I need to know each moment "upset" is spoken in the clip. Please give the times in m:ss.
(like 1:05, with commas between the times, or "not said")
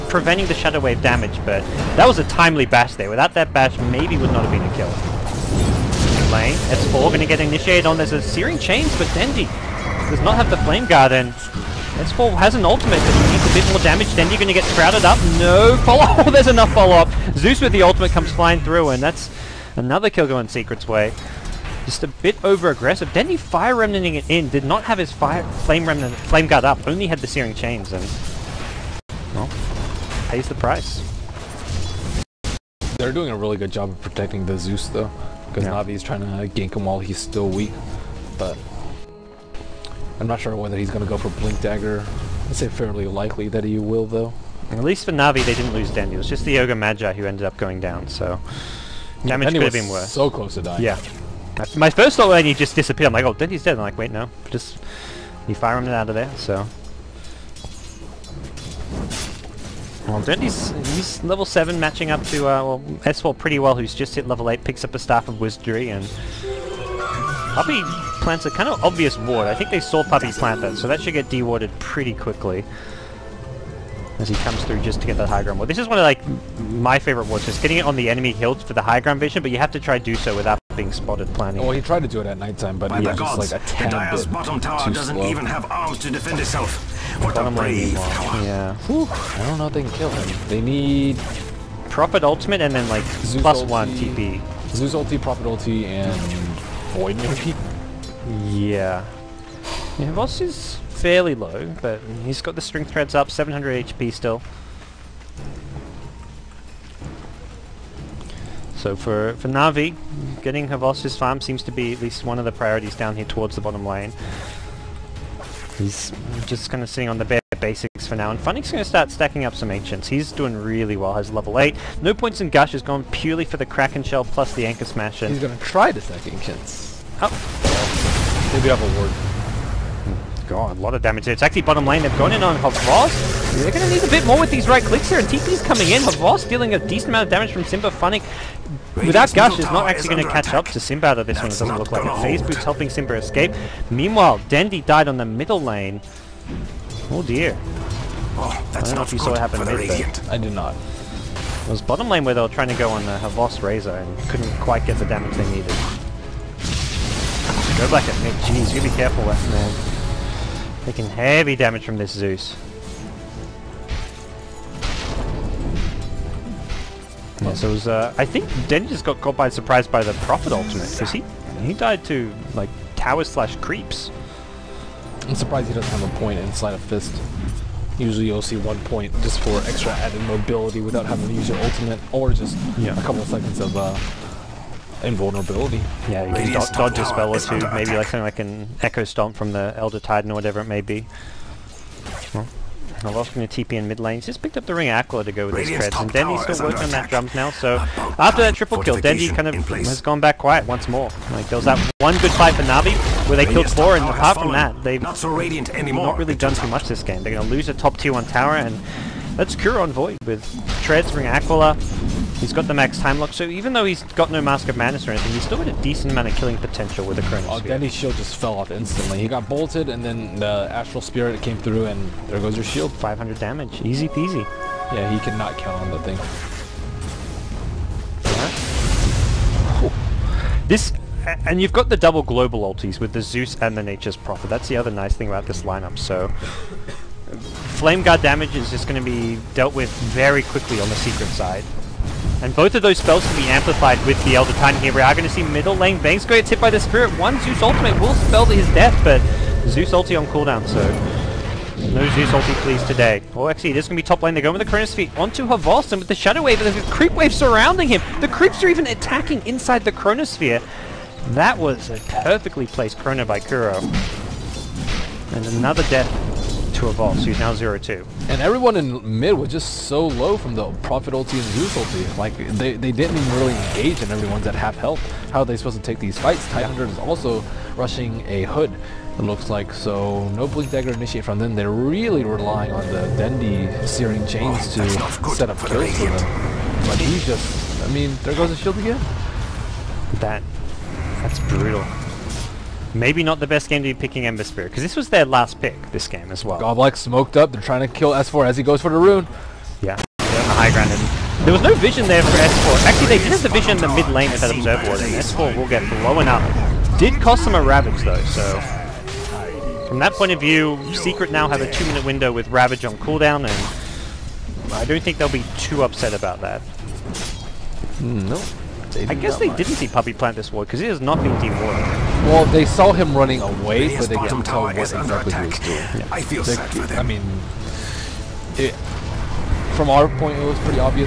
5:15.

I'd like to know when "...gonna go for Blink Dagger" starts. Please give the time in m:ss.
0:40.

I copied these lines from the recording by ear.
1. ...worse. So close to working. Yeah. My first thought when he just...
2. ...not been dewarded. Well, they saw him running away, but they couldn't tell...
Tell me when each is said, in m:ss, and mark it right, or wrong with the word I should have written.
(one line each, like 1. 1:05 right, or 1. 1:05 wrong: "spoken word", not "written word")
1. 0:49 wrong: "dying", not "working"
2. 5:20 right.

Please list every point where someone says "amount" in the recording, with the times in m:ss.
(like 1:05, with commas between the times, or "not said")
2:17, 3:36.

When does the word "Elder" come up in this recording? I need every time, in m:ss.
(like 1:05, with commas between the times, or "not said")
3:09, 4:04.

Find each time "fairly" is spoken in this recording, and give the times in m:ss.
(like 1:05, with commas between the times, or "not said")
0:42, 1:40.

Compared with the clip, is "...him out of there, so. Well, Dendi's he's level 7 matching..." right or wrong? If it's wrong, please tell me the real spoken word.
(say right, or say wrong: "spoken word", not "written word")
right.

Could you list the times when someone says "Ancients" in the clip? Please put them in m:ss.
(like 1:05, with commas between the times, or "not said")
1:59, 2:06.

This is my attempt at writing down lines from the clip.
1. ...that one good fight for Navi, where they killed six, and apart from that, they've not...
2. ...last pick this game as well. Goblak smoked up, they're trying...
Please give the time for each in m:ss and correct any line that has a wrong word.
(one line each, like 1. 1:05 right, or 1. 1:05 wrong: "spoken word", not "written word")
1. 3:21 wrong: "four", not "six"
2. 4:55 right.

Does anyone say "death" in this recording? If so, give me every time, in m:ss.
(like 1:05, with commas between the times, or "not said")
4:08, 4:25.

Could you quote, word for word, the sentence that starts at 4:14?
They're going with the Chronosphere onto Havostan with the Shadow Wave and the Creep Wave surrounding him.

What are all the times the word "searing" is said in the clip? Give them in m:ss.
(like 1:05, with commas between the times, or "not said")
0:08, 0:27, 4:43.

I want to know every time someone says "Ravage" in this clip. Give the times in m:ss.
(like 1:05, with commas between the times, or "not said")
5:07, 5:12.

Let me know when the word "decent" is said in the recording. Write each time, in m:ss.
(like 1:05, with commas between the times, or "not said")
2:16, 3:35.